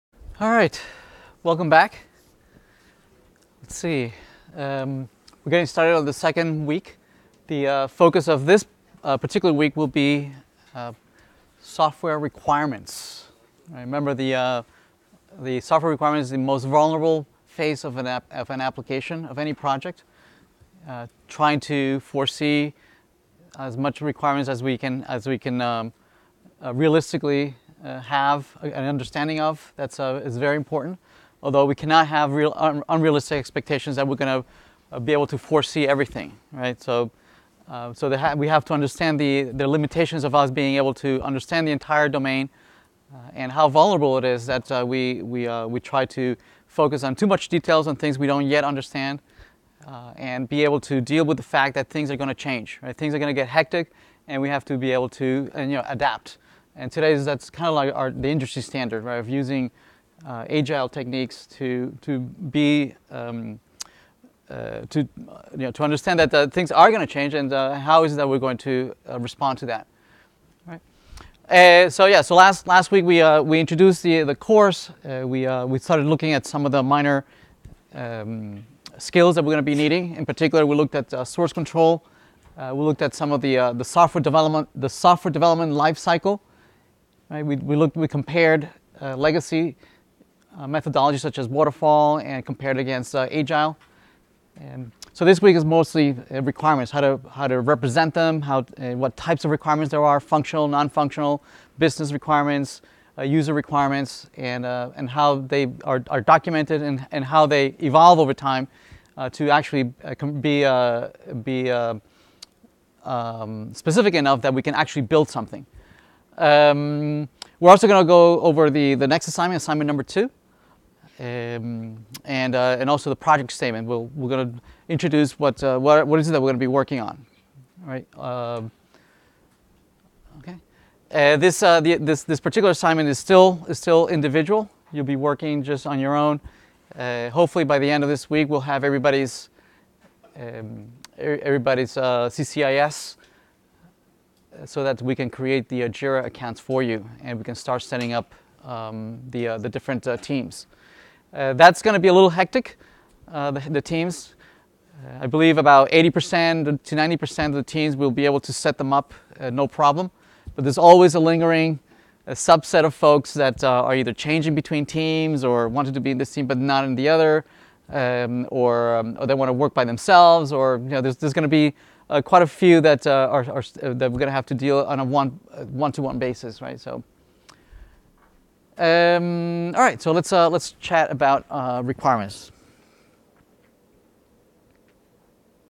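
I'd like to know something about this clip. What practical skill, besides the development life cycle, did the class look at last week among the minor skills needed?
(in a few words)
Source control.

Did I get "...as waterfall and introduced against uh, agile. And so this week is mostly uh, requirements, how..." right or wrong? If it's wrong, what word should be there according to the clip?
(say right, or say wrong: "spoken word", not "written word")
wrong: "compared", not "introduced".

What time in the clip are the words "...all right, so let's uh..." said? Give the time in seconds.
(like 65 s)
179 s.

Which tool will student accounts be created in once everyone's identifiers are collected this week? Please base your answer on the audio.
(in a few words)
Jira.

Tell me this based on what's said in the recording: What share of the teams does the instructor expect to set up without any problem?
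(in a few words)
80% to 90%.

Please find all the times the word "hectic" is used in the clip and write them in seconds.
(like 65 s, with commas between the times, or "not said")
53 s, 152 s.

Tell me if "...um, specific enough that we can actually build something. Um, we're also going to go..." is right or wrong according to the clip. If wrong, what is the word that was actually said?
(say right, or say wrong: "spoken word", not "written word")
right.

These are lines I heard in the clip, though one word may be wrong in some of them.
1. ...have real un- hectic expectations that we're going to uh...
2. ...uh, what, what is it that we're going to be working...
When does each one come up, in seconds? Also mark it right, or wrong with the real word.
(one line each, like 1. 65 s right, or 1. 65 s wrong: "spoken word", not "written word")
1. 32 s wrong: "unrealistic", not "hectic"
2. 125 s right.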